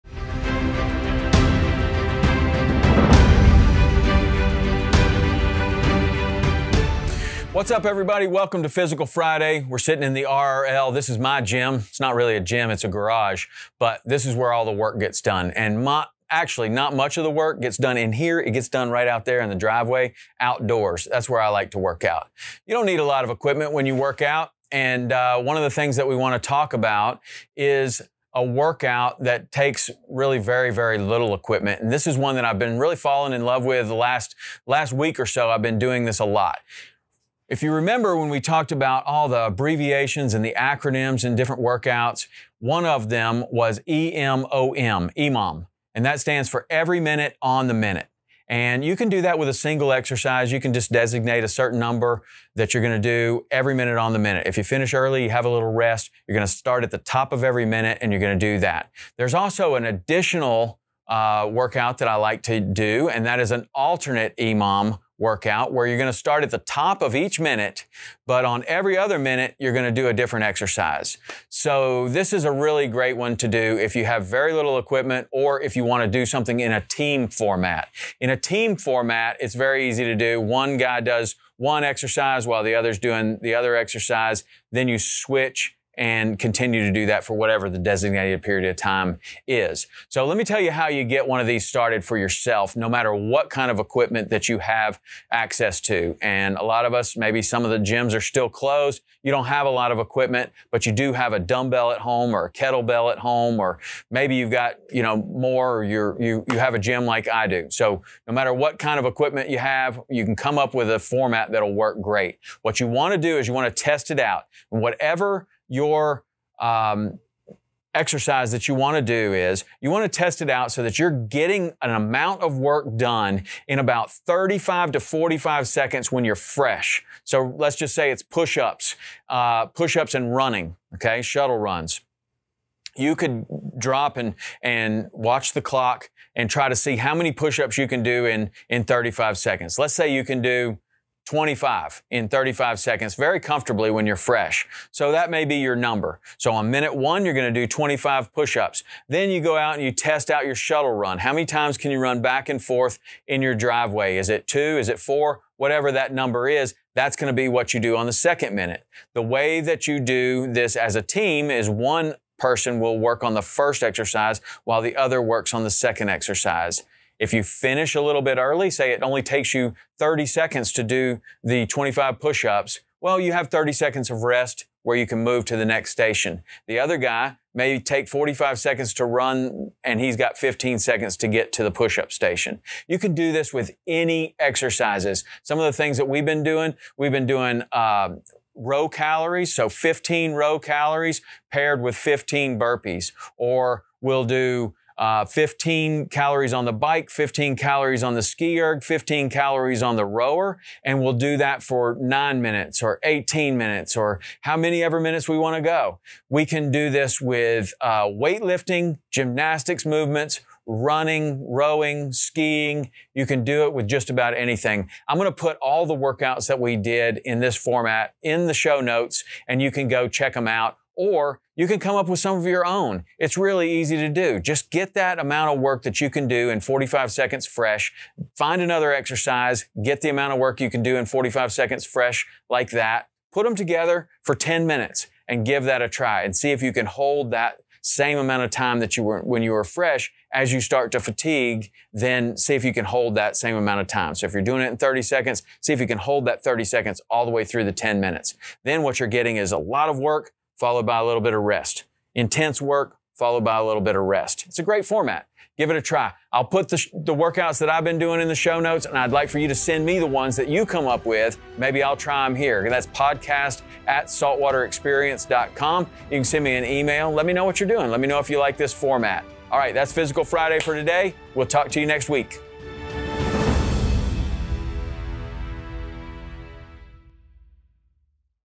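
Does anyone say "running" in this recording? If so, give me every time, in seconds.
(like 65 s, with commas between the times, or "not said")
130 s, 210 s.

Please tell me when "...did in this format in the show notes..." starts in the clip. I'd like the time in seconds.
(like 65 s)
216 s.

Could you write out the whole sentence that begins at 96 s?
And a lot of us, maybe some of the gyms are still closed.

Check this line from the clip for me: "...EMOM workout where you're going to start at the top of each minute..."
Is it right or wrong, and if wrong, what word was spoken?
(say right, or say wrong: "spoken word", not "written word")
right.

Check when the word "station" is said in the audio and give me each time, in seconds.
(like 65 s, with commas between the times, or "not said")
175 s, 182 s.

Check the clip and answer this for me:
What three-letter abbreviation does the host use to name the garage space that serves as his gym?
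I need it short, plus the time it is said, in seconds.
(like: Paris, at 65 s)
RRL, at 10 s.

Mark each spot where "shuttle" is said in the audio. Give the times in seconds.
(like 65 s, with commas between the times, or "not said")
131 s, 150 s.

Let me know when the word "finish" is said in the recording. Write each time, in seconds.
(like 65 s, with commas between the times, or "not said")
54 s, 167 s.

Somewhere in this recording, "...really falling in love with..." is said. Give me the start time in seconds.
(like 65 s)
32 s.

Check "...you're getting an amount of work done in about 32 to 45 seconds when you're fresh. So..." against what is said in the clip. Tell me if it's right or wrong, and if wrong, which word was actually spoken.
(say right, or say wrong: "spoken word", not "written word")
wrong: "35", not "32".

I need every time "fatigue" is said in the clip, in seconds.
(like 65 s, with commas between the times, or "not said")
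240 s.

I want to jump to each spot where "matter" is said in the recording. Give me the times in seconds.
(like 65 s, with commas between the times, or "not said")
92 s, 108 s.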